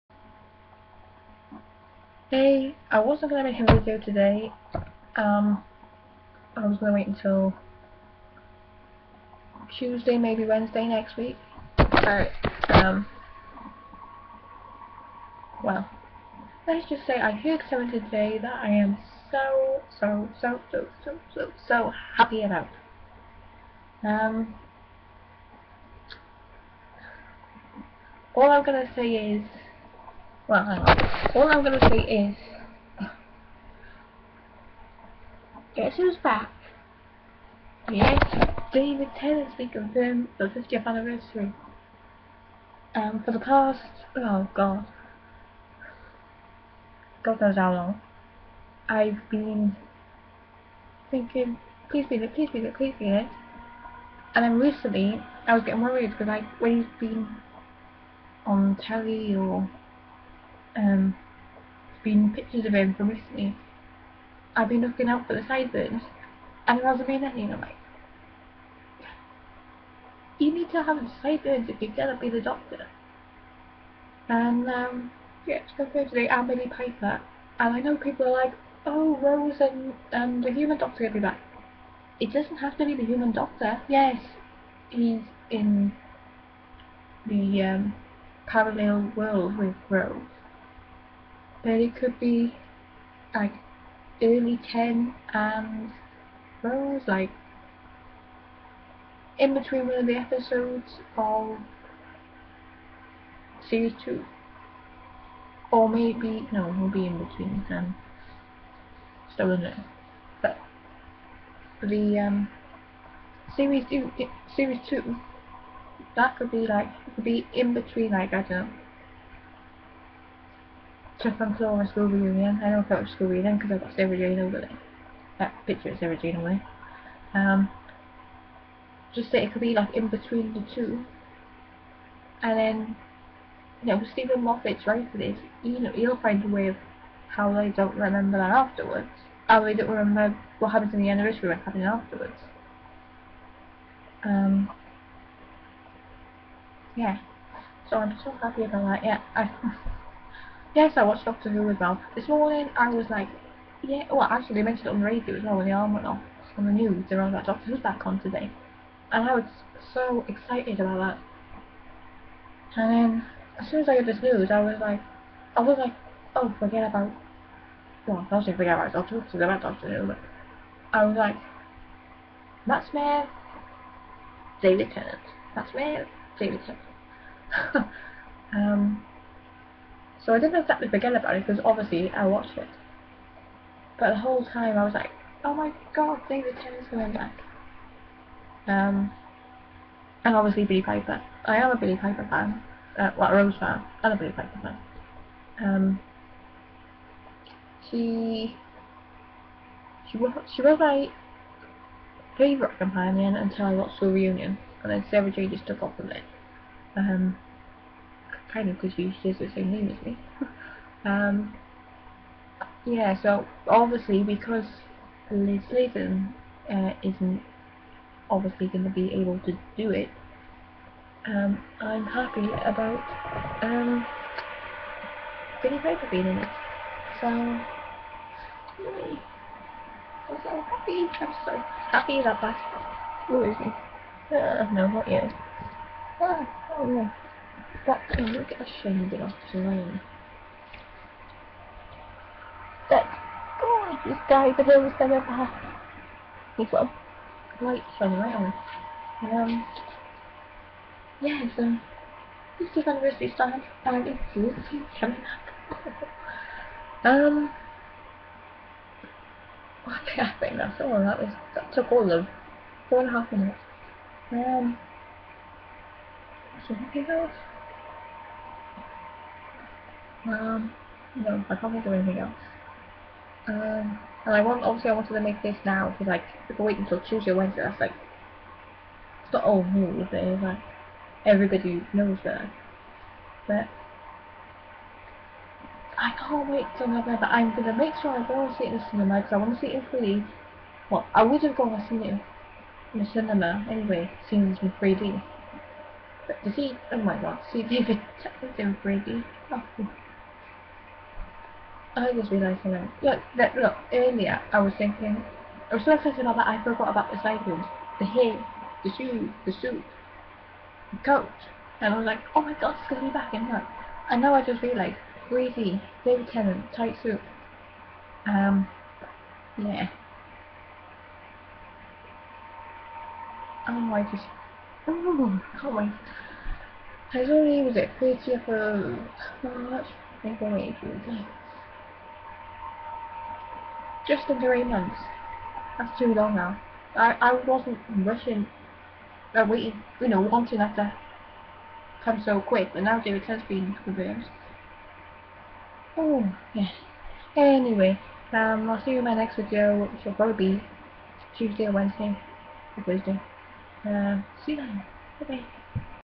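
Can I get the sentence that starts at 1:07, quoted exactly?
I'm like, you need to have the sideburns if you're gonna be the doctor.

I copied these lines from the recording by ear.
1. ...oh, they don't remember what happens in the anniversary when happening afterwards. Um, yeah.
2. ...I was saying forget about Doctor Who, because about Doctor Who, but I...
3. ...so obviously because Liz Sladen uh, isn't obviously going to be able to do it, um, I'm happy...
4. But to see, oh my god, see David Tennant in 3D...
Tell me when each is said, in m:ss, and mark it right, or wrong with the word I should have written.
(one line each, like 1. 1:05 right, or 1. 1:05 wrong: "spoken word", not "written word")
1. 2:19 right
2. 2:48 right
3. 3:33 right
4. 4:56 right.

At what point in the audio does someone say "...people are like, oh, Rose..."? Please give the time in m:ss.
1:17.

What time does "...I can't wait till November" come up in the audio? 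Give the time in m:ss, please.
4:45.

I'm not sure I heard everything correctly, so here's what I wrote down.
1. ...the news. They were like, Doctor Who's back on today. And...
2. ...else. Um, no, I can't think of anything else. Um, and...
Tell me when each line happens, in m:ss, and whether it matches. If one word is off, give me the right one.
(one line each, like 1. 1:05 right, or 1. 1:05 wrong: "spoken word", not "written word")
1. 2:36 right
2. 4:27 right.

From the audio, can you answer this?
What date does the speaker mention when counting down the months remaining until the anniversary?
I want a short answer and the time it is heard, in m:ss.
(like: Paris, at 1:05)
30th of March, at 5:27.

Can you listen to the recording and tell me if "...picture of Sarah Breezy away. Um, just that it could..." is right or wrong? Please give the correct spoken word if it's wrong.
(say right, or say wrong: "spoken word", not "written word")
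wrong: "Jane", not "Breezy".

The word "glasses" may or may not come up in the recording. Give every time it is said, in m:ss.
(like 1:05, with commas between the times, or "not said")
not said.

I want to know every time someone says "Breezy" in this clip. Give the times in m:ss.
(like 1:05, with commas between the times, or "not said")
5:15.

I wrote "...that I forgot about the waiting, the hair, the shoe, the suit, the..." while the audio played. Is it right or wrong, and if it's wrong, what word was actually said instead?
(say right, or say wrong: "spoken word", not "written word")
wrong: "cycling", not "waiting".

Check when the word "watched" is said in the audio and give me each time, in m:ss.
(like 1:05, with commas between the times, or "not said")
2:31, 3:02, 3:23.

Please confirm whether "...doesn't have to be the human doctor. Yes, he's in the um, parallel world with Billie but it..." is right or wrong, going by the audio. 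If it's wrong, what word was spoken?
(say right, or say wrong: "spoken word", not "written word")
wrong: "Rose", not "Billie".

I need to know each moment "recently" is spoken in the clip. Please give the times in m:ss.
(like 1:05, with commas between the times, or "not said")
0:54, 1:03.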